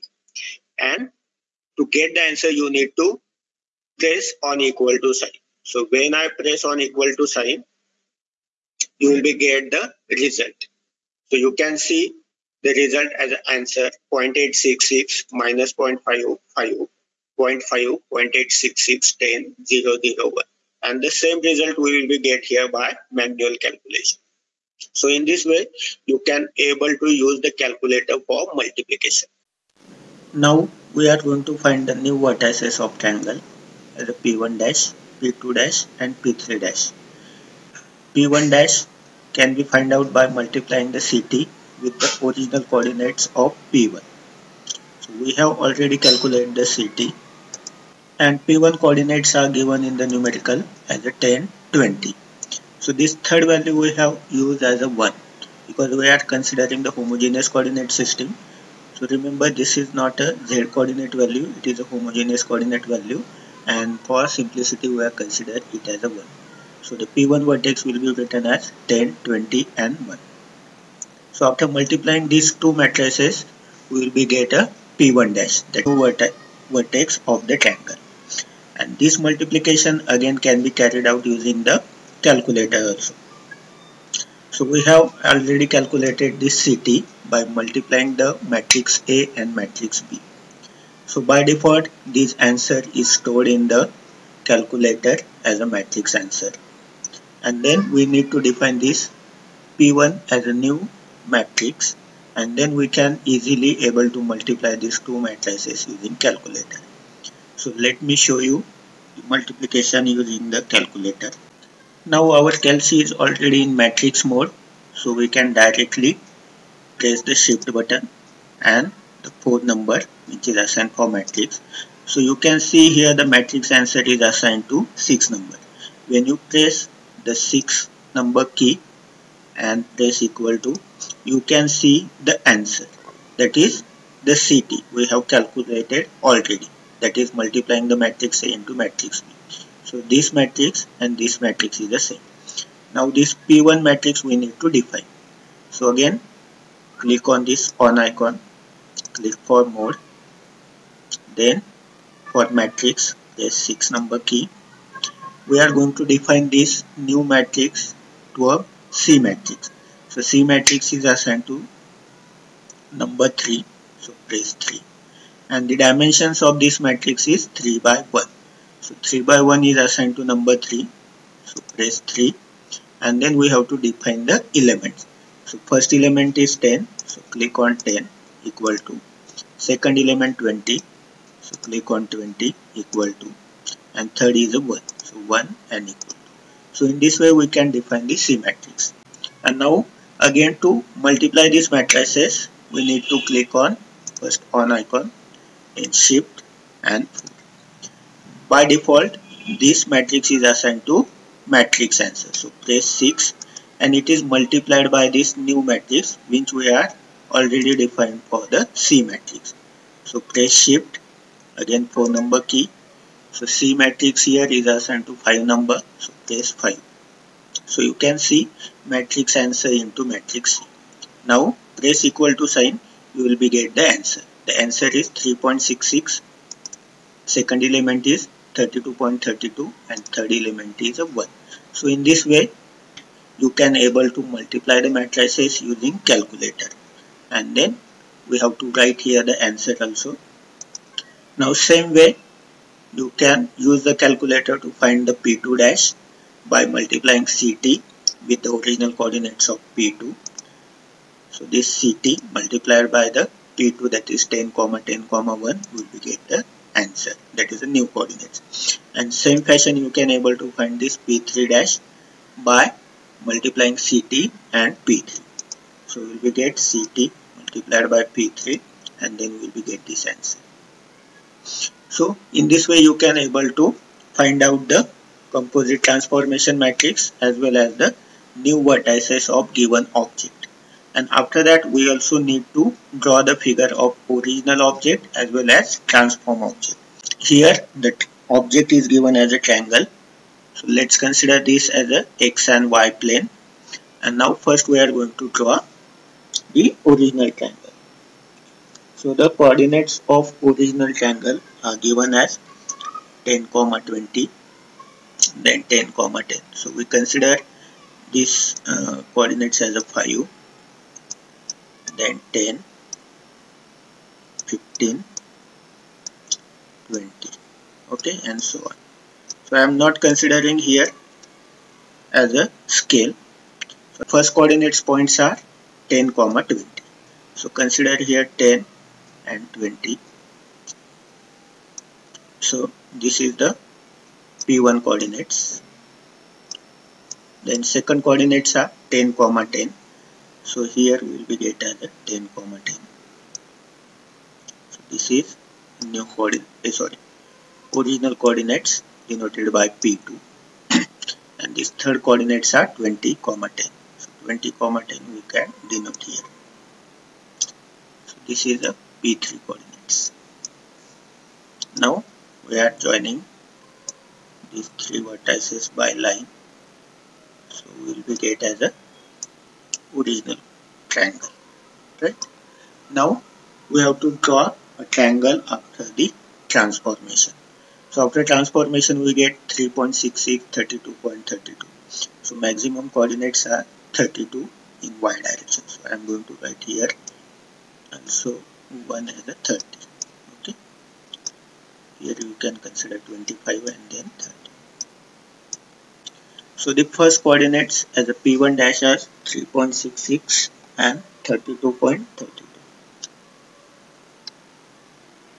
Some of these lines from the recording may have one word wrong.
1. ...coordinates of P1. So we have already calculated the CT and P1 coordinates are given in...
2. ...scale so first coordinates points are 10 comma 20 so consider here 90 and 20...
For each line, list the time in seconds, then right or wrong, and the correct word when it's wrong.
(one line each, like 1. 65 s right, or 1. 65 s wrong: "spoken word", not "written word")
1. 42 s right
2. 322 s wrong: "10", not "90".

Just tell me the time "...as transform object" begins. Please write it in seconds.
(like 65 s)
285 s.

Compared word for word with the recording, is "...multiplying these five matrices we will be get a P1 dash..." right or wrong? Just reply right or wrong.
wrong.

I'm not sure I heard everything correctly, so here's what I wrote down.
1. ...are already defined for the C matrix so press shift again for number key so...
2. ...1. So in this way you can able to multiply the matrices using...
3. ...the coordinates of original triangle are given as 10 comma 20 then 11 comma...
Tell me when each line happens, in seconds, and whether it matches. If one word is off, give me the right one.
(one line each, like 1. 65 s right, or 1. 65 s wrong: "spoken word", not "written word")
1. 206 s right
2. 231 s right
3. 299 s wrong: "10", not "11".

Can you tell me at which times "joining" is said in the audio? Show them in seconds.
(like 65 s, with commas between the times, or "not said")
362 s.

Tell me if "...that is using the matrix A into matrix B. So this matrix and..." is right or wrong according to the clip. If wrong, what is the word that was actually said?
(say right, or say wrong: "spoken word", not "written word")
wrong: "multiplying", not "using".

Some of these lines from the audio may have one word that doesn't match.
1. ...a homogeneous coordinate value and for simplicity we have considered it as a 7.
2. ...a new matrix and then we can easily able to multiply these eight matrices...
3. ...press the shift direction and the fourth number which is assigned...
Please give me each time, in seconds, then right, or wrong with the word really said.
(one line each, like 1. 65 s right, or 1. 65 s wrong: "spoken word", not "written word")
1. 61 s wrong: "1", not "7"
2. 100 s wrong: "two", not "eight"
3. 117 s wrong: "button", not "direction".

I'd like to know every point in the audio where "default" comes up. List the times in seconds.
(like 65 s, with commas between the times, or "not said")
91 s, 198 s.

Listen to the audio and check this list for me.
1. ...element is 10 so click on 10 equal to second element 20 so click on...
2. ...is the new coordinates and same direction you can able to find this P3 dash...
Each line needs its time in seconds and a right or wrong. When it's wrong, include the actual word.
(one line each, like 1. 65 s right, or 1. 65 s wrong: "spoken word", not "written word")
1. 175 s right
2. 257 s wrong: "fashion", not "direction".